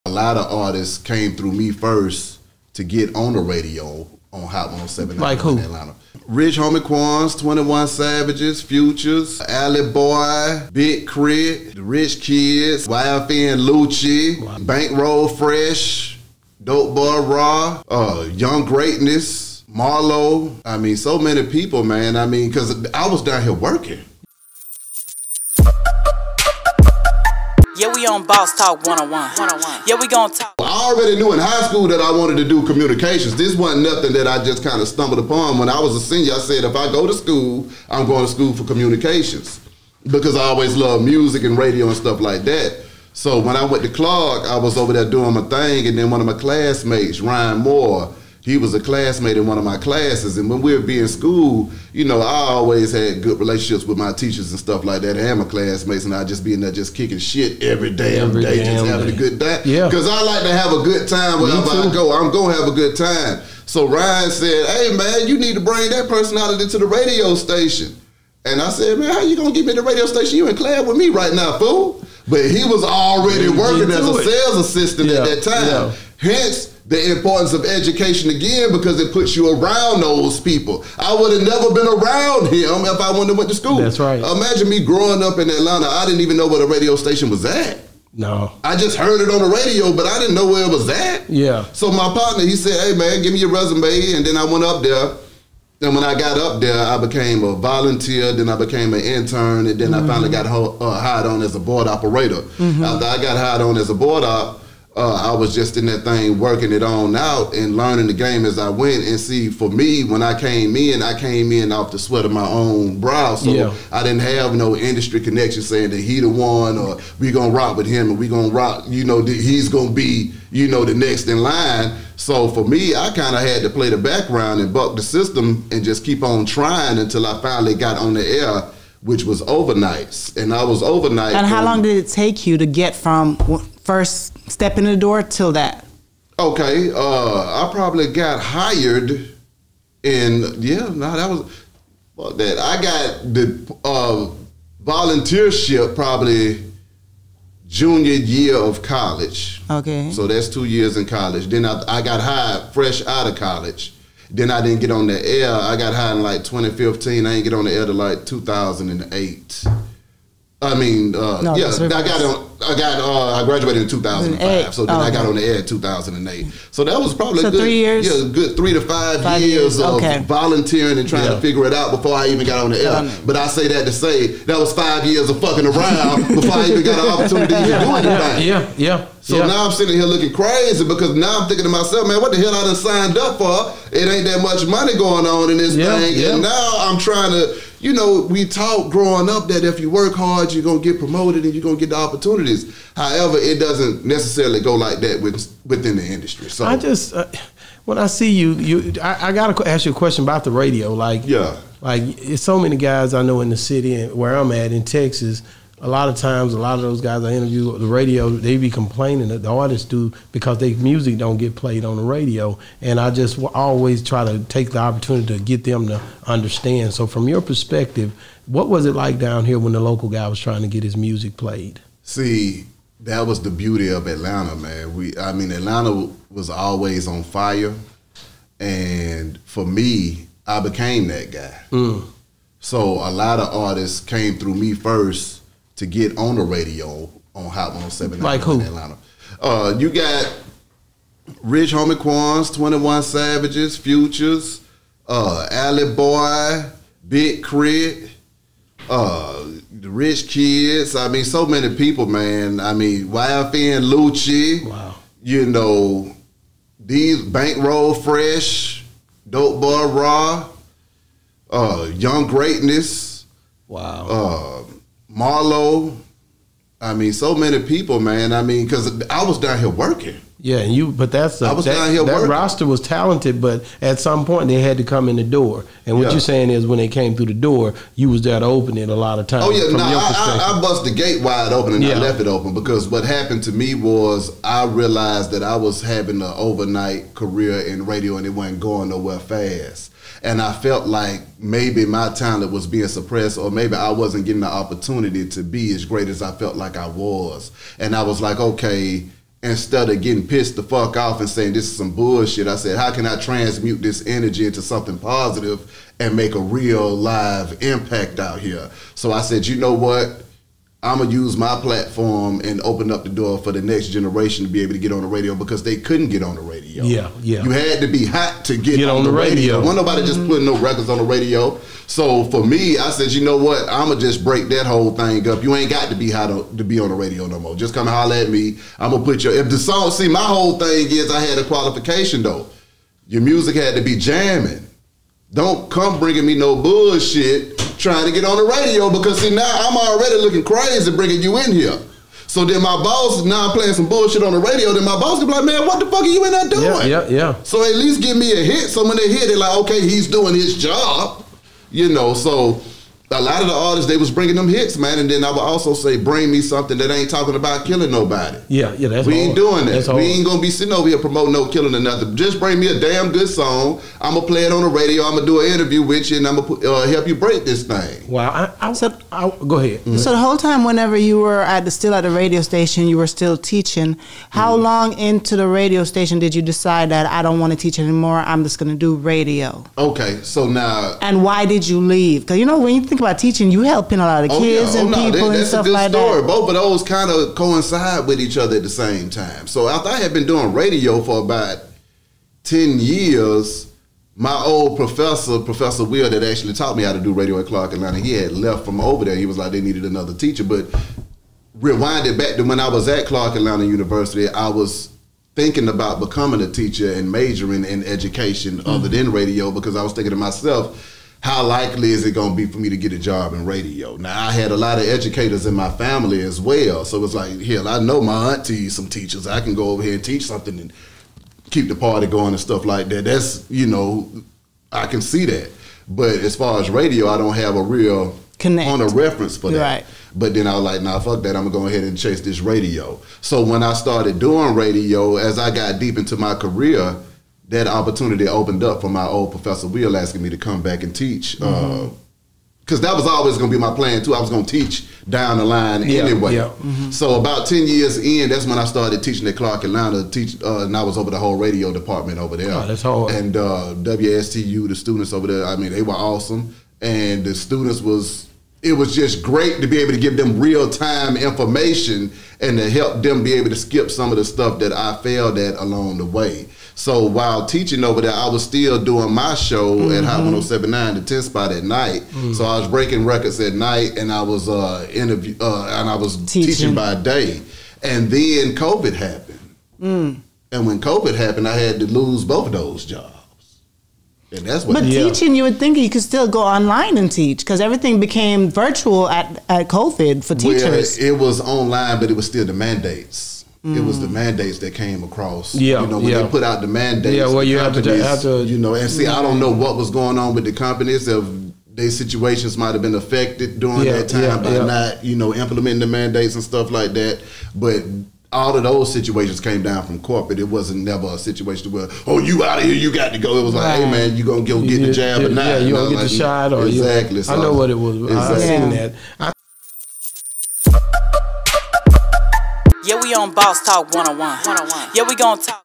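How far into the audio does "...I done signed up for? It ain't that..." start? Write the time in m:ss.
3:02.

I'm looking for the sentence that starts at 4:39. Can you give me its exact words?
Oh yeah, no, nah, I, I, I bust the gate wide open and yeah.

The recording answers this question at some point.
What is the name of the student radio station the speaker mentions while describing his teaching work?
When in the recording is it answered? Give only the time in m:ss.
7:33.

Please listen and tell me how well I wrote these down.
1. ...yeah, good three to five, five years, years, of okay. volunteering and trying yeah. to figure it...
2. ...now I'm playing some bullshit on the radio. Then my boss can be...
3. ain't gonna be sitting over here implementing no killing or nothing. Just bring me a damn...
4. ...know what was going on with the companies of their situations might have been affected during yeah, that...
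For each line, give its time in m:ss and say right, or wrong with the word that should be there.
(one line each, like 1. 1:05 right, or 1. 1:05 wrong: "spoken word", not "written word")
1. 2:48 right
2. 5:43 right
3. 6:00 wrong: "promoting", not "implementing"
4. 8:19 right.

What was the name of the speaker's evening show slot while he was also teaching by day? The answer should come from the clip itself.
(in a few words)
the 10 spot.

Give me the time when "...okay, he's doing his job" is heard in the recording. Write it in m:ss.
5:49.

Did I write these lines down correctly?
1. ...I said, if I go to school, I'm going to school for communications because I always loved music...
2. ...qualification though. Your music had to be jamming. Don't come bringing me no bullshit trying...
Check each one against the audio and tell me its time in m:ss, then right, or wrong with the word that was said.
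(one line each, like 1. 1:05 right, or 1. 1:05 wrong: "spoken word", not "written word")
1. 0:36 right
2. 5:31 right.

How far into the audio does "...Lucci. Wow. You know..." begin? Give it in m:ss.
4:13.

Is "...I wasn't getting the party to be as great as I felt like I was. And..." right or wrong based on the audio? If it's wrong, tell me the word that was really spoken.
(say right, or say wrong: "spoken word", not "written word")
wrong: "opportunity", not "party".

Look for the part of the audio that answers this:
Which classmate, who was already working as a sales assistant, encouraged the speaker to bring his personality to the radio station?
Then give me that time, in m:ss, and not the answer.
0:47.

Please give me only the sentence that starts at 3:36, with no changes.
So, from your perspective, what was it like down here when the local guy was trying to get his music played?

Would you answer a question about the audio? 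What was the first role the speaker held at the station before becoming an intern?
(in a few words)
volunteer.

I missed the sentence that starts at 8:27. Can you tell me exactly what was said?
But all of those situations came down from corporate.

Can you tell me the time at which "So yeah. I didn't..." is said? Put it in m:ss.
1:53.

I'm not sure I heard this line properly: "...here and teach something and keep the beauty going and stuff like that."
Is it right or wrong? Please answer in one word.
wrong.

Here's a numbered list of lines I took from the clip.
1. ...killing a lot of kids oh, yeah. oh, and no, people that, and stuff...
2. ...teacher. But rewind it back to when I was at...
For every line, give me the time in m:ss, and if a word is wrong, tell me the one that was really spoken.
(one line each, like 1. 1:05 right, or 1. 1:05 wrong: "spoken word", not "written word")
1. 6:23 wrong: "helping", not "killing"
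2. 6:40 right.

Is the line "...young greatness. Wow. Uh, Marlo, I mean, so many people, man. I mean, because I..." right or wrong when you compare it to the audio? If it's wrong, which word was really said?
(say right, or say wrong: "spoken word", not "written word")
right.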